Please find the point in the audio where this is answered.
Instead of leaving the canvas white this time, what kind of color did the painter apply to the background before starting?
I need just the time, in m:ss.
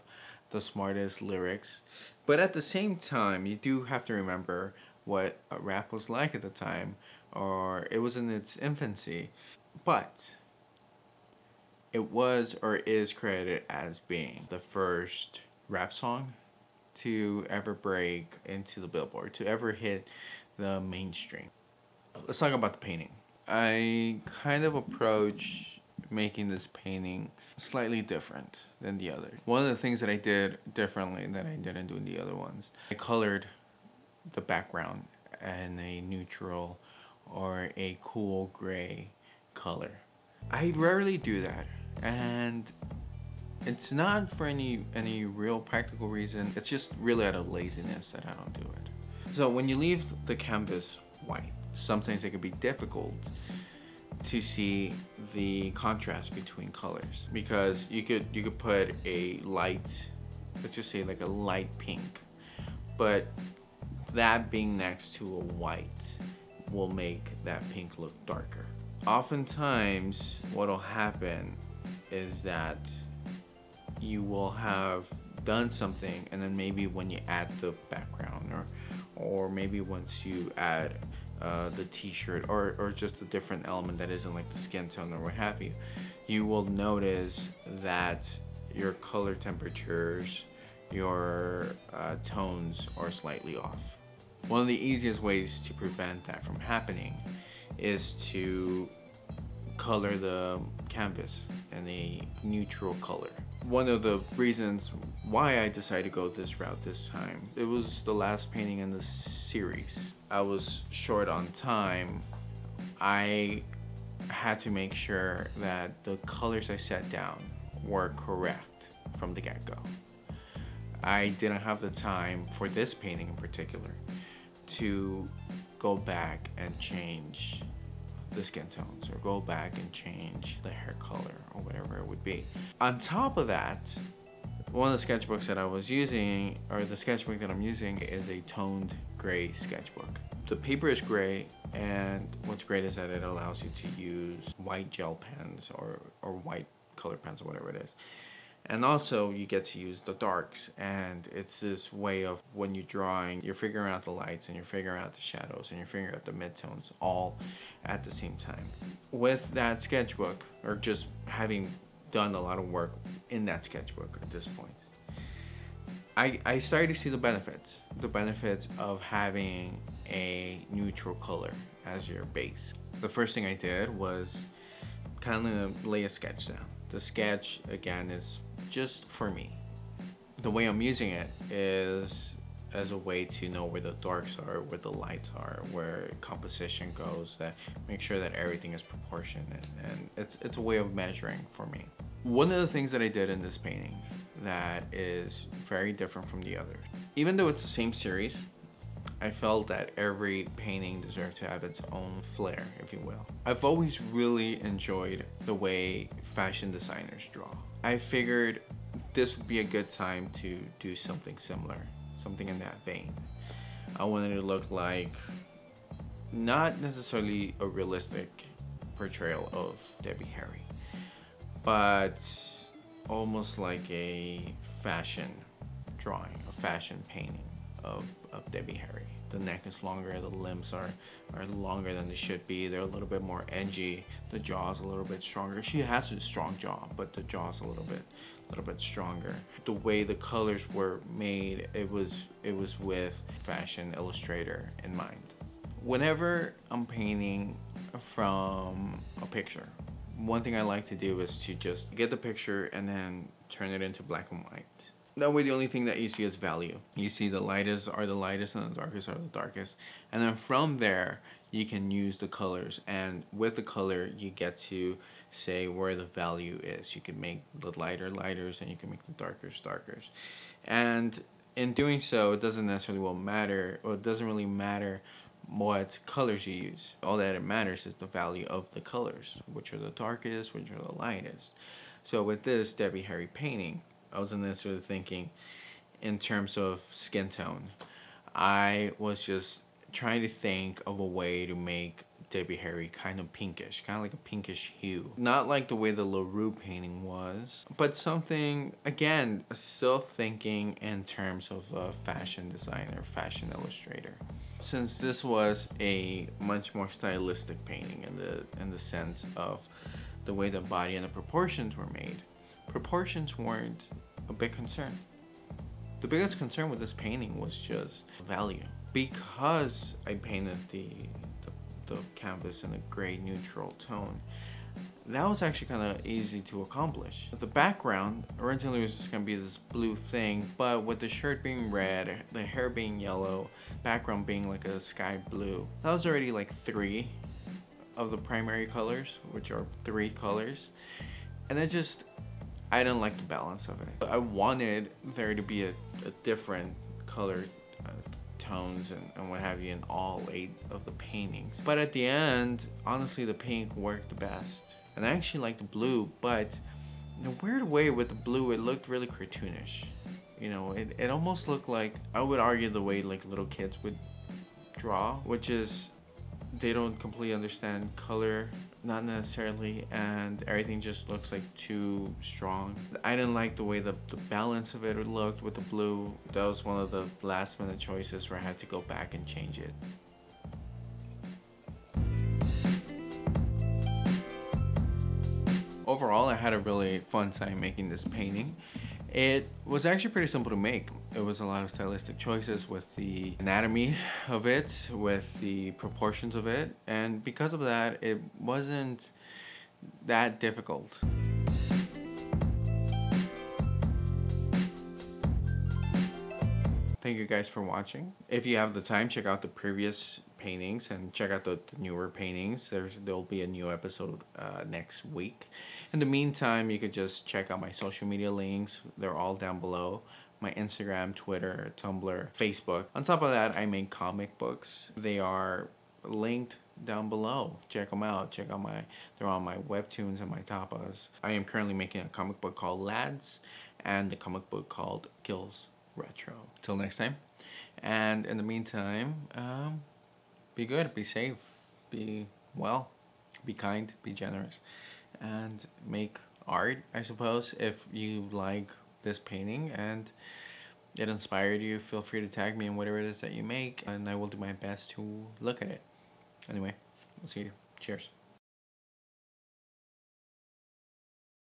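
0:38.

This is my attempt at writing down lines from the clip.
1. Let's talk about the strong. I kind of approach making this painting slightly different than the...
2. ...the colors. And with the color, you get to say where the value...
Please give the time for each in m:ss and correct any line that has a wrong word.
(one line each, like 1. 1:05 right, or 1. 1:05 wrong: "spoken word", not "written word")
1. 0:22 wrong: "painting", not "strong"
2. 4:22 right.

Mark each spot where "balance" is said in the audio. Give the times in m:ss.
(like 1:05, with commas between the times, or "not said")
5:43, 6:14.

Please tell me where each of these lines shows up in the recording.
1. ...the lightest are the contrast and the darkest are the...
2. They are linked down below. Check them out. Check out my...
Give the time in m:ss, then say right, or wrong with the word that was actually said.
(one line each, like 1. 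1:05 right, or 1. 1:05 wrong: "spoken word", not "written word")
1. 4:17 wrong: "lightest", not "contrast"
2. 7:04 right.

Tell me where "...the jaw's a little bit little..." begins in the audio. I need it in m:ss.
3:57.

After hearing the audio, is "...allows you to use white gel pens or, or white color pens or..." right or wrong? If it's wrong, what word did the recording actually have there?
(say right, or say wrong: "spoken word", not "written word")
right.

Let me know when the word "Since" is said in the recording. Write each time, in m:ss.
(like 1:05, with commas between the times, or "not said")
5:04.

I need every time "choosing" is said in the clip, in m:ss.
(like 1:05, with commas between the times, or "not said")
not said.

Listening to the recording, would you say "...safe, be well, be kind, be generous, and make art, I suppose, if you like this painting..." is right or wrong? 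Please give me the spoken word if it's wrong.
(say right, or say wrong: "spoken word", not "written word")
right.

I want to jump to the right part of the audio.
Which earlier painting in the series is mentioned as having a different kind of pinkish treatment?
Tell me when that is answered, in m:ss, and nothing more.
4:56.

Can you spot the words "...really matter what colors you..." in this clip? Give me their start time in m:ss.
4:34.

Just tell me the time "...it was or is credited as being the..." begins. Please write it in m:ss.
0:11.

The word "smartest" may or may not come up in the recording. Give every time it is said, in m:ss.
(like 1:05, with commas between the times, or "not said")
0:00.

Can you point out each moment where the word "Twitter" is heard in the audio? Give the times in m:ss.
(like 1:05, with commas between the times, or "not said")
7:01.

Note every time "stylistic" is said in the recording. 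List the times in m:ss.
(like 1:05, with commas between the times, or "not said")
5:06, 6:31.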